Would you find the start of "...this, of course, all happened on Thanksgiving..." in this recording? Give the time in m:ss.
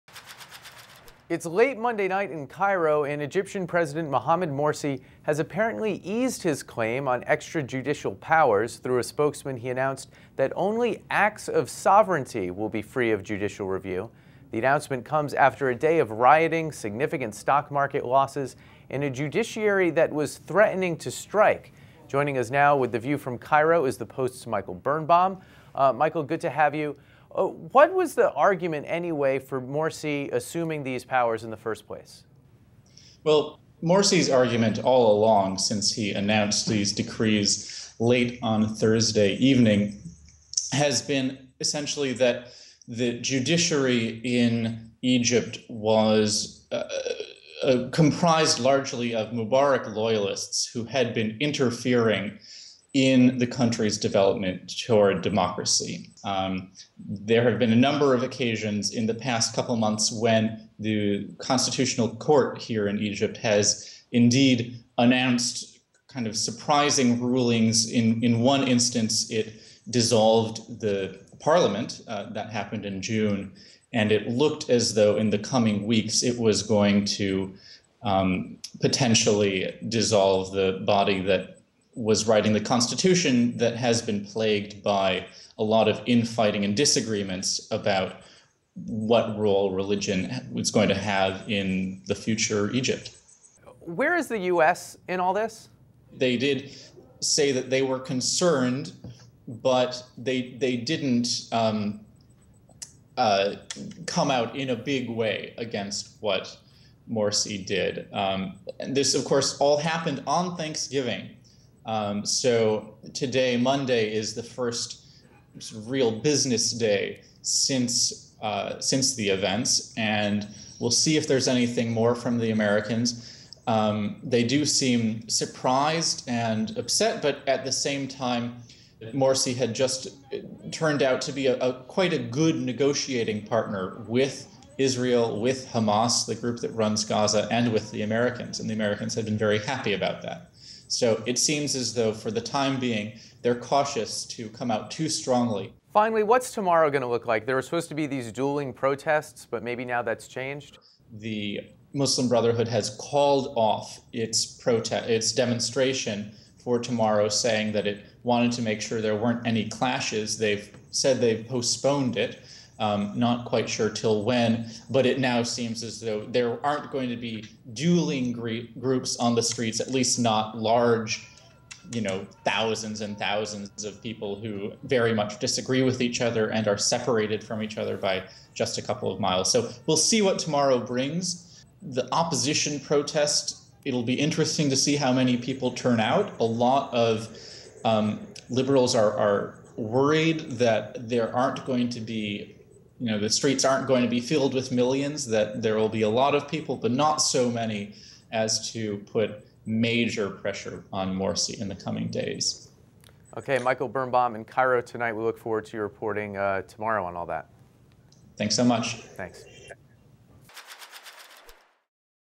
1:48.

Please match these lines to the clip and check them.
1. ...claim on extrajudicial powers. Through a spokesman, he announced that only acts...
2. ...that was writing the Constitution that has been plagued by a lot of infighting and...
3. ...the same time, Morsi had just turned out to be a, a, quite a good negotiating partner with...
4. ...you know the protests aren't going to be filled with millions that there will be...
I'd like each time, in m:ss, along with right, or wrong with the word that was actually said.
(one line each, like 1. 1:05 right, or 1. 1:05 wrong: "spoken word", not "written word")
1. 0:06 right
2. 1:21 right
3. 2:07 right
4. 3:13 wrong: "streets", not "protests".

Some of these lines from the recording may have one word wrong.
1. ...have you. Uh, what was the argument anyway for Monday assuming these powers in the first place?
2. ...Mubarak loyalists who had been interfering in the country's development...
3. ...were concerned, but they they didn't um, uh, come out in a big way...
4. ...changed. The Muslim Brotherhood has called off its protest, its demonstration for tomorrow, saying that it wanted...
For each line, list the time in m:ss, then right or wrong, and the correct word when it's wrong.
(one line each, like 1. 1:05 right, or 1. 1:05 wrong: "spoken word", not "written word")
1. 0:26 wrong: "Morsi", not "Monday"
2. 0:49 right
3. 1:37 right
4. 2:30 right.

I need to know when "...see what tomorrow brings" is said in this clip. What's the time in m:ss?
2:59.